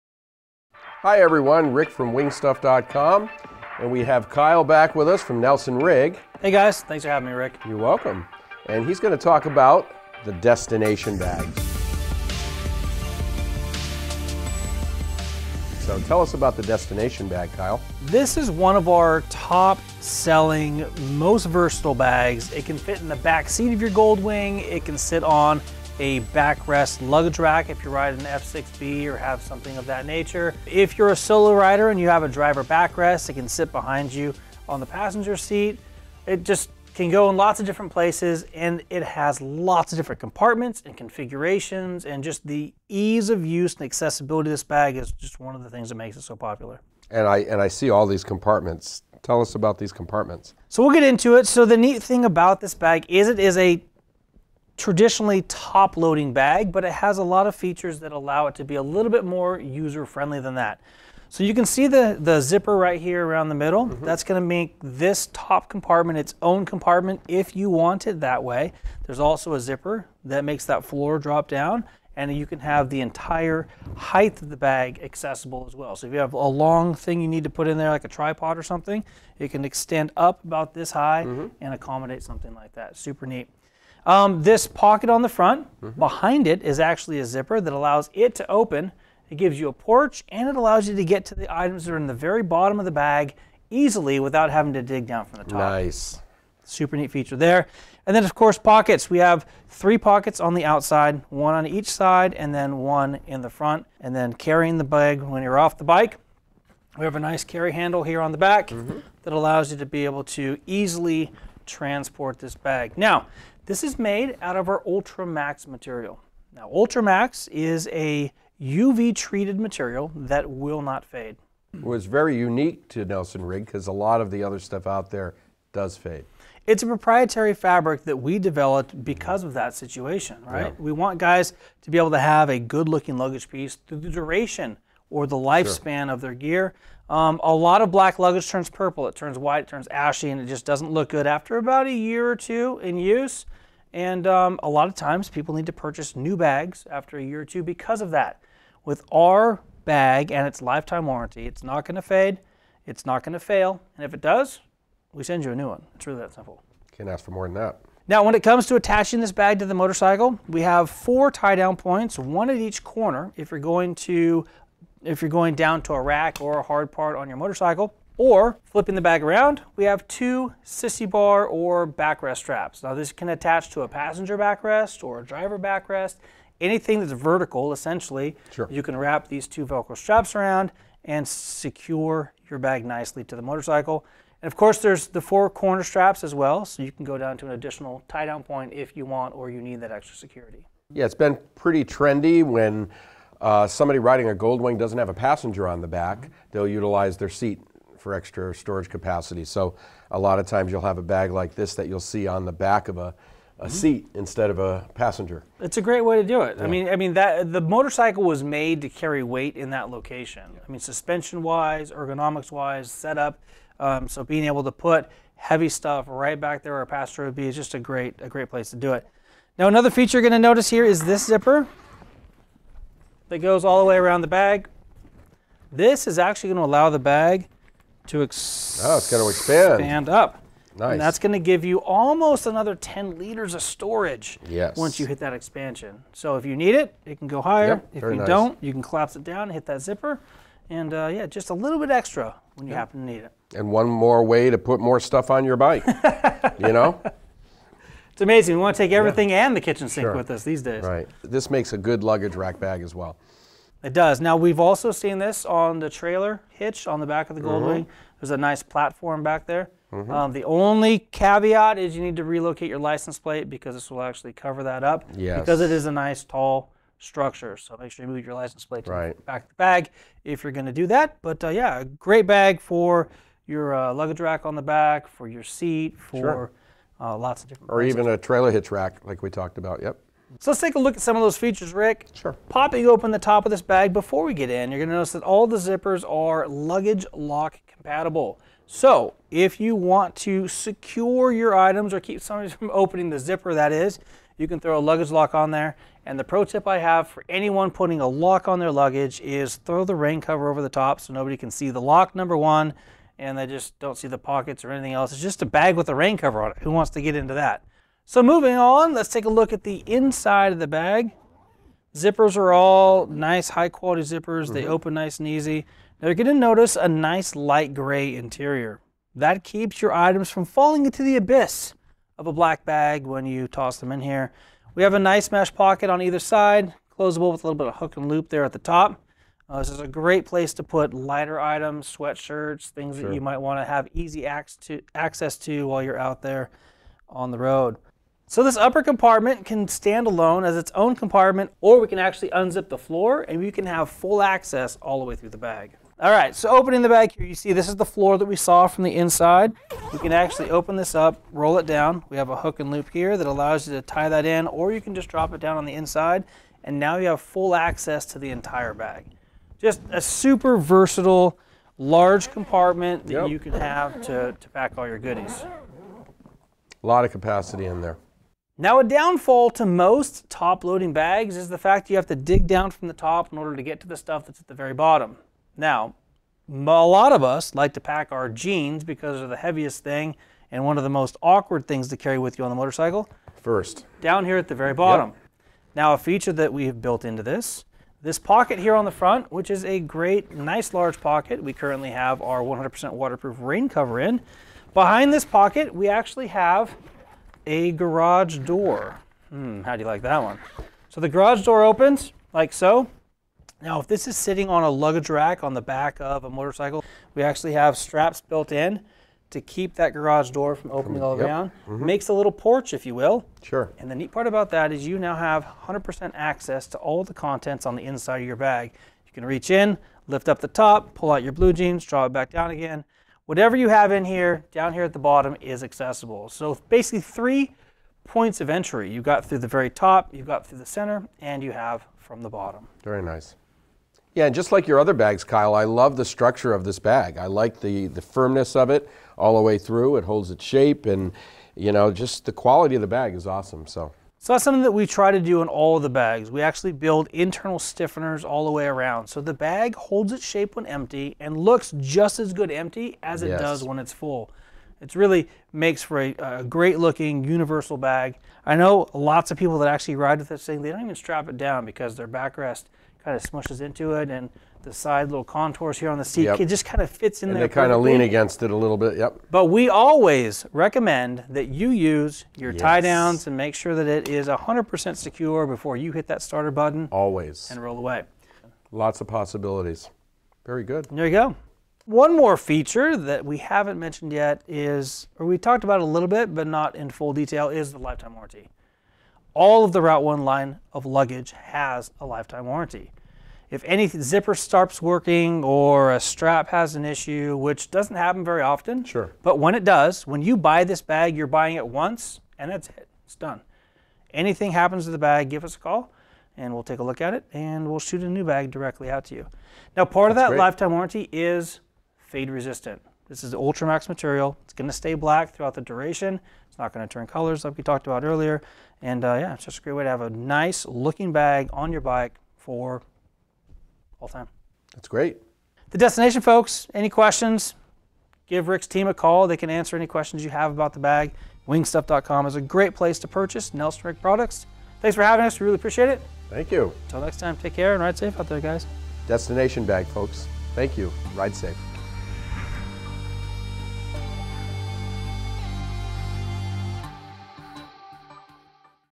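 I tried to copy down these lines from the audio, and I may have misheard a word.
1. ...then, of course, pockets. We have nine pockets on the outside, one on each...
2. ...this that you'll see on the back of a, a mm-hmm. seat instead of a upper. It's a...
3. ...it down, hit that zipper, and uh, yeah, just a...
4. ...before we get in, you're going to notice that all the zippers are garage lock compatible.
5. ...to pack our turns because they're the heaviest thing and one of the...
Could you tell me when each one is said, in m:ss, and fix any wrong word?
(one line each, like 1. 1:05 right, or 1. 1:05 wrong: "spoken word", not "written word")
1. 1:38 wrong: "three", not "nine"
2. 3:21 wrong: "passenger", not "upper"
3. 3:59 right
4. 4:43 wrong: "luggage", not "garage"
5. 6:17 wrong: "jeans", not "turns".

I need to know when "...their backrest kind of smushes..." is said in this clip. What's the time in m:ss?
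7:41.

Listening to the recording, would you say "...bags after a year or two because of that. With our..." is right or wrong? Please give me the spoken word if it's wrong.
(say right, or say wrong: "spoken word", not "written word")
right.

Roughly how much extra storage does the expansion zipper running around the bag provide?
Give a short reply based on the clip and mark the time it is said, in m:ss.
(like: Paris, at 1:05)
10 liters, at 3:52.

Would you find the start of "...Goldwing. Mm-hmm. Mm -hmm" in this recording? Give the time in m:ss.
4:17.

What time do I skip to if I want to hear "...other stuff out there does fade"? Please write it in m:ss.
2:04.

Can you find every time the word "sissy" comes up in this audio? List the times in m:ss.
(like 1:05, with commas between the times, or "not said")
2:50.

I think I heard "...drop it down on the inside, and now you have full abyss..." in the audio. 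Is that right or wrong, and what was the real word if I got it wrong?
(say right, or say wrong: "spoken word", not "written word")
wrong: "access", not "abyss".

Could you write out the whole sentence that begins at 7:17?
I like the, the firmness of it all the way through.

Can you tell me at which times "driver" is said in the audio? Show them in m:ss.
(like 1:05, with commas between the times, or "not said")
0:32, 2:55.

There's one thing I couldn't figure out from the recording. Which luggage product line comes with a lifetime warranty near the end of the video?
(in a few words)
Route 1.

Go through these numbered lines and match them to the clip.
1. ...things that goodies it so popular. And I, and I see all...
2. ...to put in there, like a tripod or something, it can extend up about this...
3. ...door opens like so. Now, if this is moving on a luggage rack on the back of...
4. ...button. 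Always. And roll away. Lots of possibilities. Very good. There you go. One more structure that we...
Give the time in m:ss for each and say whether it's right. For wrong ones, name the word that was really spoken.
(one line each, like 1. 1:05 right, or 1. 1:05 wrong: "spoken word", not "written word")
1. 0:45 wrong: "makes", not "goodies"
2. 1:17 right
3. 6:41 wrong: "sitting", not "moving"
4. 7:56 wrong: "feature", not "structure".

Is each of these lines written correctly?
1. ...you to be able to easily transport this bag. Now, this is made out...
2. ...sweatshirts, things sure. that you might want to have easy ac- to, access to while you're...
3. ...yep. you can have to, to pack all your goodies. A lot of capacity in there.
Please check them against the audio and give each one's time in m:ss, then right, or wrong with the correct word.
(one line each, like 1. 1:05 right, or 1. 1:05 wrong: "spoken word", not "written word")
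1. 1:49 right
2. 5:31 right
3. 6:03 right.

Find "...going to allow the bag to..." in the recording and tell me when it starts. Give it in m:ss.
3:46.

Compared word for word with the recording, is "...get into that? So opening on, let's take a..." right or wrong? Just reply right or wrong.
wrong.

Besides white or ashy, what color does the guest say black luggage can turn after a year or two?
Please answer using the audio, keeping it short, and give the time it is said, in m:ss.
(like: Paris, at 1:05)
Purple, at 2:18.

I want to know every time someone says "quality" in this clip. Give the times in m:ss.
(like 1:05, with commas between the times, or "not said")
5:13, 7:22.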